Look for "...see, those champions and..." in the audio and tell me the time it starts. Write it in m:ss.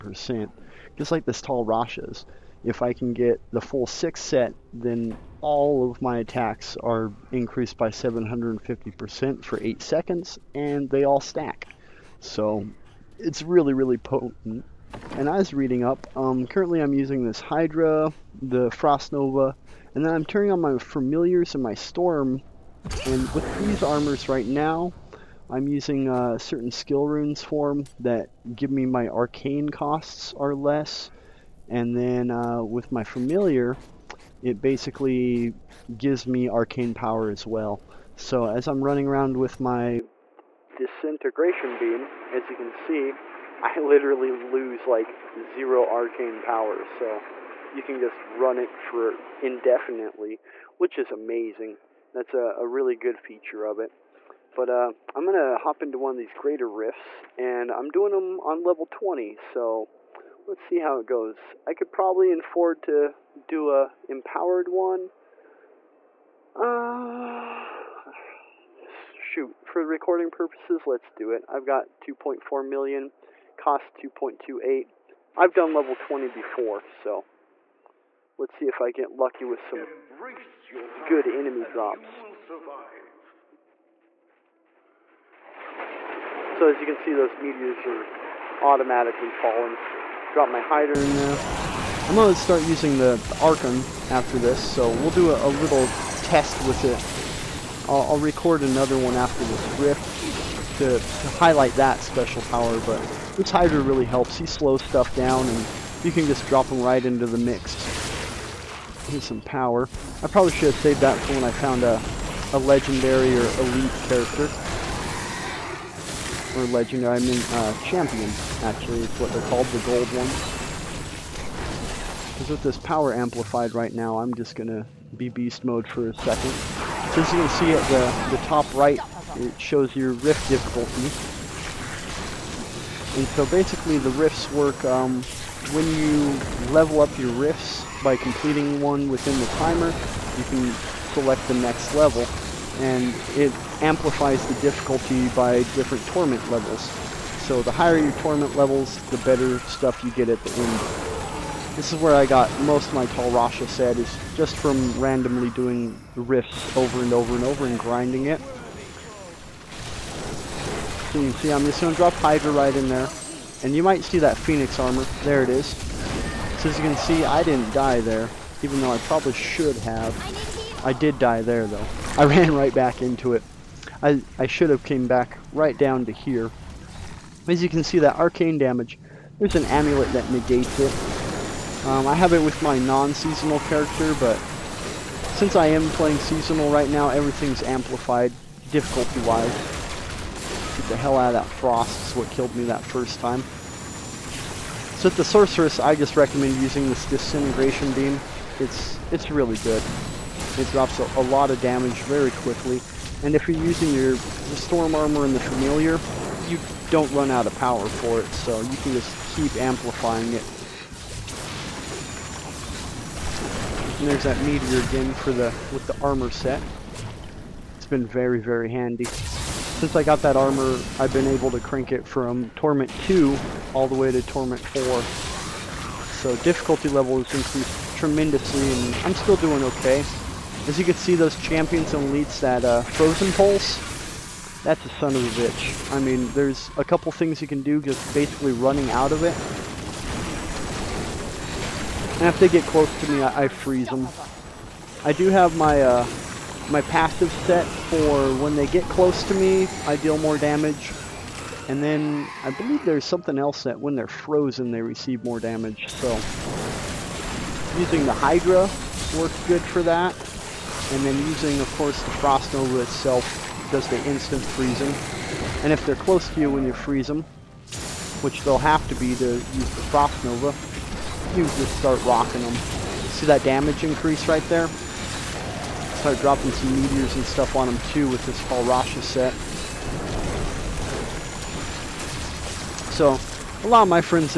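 3:50.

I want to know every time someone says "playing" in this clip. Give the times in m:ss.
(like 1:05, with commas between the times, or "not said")
3:05.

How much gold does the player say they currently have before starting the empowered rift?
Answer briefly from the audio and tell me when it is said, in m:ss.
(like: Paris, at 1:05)
2.4 million, at 1:11.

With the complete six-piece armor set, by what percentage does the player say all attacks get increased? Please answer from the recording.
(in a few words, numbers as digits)
750%.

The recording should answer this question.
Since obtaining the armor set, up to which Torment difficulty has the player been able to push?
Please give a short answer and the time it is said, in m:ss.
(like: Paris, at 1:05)
Torment 4, at 3:44.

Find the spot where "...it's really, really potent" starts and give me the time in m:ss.
0:13.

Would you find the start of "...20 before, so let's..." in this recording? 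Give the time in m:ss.
1:15.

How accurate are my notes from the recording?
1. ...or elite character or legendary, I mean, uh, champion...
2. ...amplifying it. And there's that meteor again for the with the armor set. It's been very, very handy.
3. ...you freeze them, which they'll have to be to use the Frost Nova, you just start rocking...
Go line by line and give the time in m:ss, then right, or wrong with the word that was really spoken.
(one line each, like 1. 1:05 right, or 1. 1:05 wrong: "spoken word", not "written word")
1. 1:53 right
2. 3:29 right
3. 4:26 right.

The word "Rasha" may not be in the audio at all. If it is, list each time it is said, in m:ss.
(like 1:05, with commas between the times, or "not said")
0:01, 2:33, 4:38.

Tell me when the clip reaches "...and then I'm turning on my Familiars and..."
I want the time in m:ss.
0:19.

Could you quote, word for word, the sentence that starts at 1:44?
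He slows stuff down, and you can just drop him right into the mix.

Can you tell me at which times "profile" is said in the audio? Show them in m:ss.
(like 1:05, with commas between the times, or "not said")
not said.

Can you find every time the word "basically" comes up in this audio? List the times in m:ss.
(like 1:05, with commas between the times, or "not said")
0:34, 2:13, 3:58.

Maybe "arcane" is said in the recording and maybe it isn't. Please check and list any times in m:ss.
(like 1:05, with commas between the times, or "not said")
0:29, 0:36, 0:45, 2:58.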